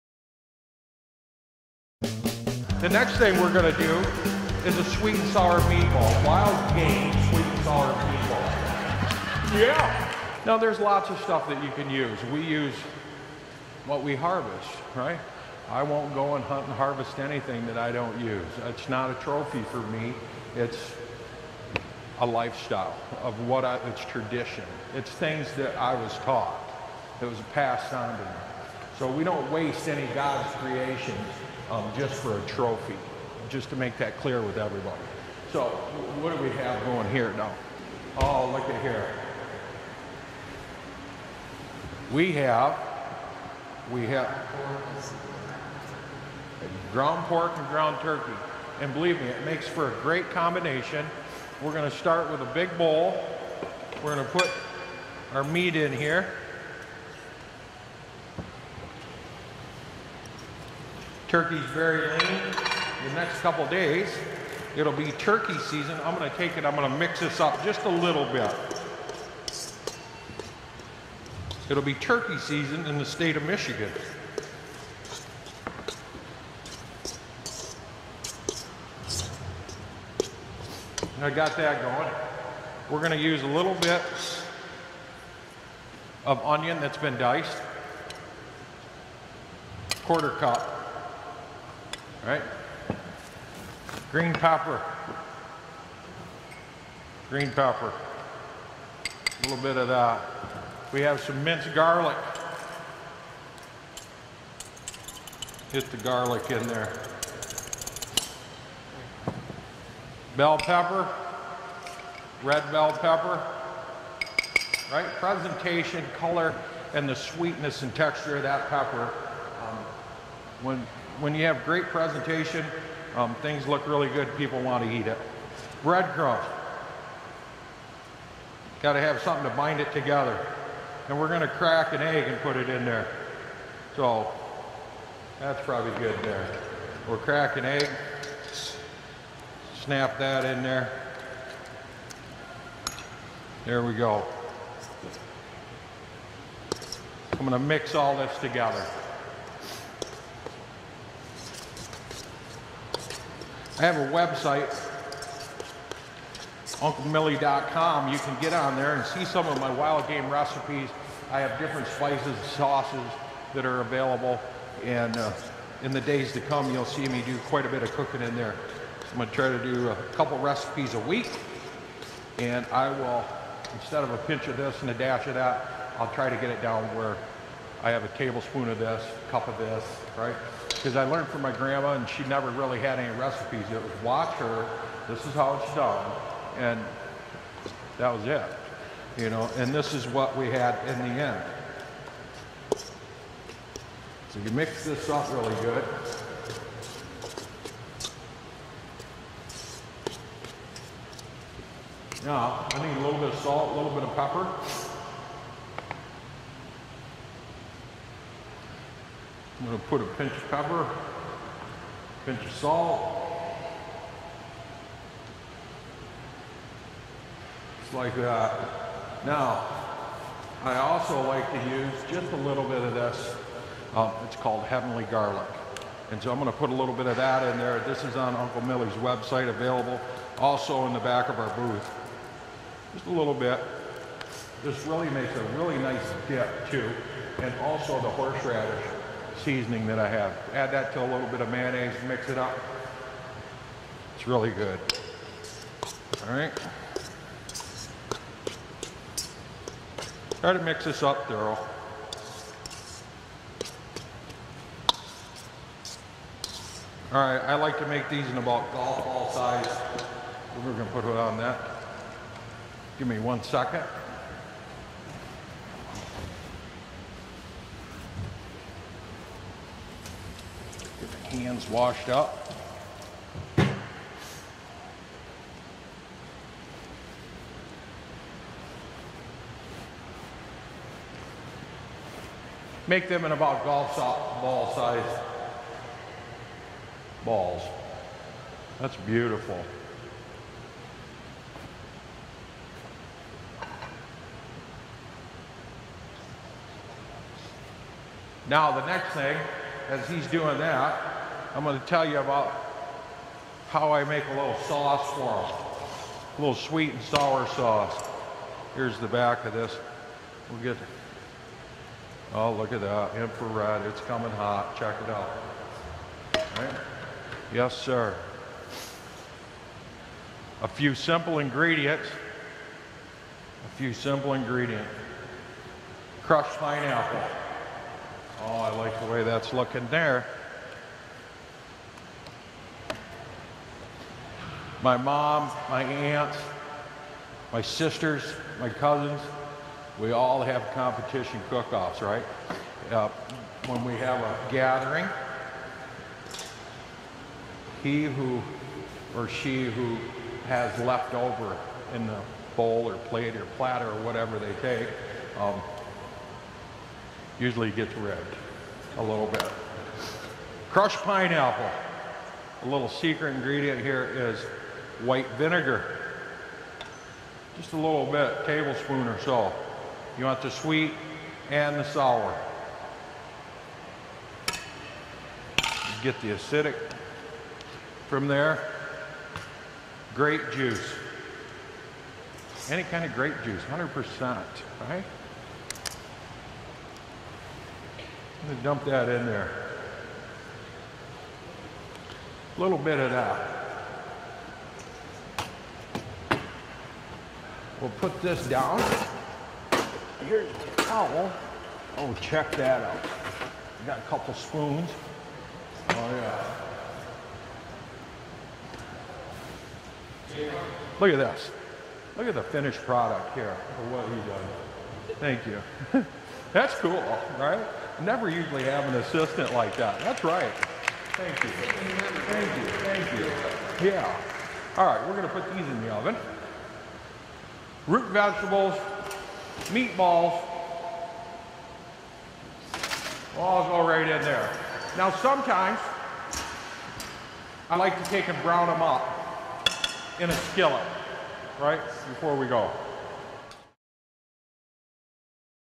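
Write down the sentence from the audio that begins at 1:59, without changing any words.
Um, when when you have great presentation, um, things look really good.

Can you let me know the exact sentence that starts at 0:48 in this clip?
And believe me, it makes for a great combination.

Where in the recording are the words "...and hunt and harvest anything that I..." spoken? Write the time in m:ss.
0:16.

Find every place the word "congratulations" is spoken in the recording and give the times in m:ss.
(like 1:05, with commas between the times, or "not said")
not said.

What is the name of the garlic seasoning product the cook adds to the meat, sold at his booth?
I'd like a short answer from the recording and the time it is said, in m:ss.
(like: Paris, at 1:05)
Heavenly garlic, at 3:44.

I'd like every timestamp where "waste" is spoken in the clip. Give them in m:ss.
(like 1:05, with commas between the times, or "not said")
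0:29.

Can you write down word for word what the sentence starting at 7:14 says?
Now sometimes I like to take and brown them up in a skillet, right, before we go.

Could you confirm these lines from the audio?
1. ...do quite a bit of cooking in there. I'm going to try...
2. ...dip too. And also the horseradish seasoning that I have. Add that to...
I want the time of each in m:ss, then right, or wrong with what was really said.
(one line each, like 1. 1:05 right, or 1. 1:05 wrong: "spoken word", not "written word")
1. 2:47 right
2. 3:56 right.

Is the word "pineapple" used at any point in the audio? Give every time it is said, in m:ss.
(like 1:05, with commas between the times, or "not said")
5:26, 6:00.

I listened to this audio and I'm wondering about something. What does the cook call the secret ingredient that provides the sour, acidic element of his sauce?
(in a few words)
White vinegar.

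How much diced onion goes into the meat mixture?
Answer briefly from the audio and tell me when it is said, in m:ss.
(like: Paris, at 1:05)
Quarter cup, at 1:30.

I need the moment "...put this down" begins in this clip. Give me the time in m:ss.
6:37.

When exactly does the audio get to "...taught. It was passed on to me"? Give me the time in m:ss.
0:26.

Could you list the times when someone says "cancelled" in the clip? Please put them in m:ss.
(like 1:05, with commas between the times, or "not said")
not said.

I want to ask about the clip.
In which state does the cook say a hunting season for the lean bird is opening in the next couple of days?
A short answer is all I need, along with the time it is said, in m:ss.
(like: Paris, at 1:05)
Michigan, at 1:13.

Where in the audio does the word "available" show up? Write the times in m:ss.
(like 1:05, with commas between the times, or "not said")
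2:43, 3:49.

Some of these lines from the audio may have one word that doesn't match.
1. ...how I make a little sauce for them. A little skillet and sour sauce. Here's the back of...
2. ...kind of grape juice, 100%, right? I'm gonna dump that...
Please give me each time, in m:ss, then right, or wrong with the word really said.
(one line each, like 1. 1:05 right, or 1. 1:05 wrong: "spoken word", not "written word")
1. 5:03 wrong: "sweet", not "skillet"
2. 6:22 right.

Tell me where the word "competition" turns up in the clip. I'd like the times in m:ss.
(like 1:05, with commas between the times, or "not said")
5:40.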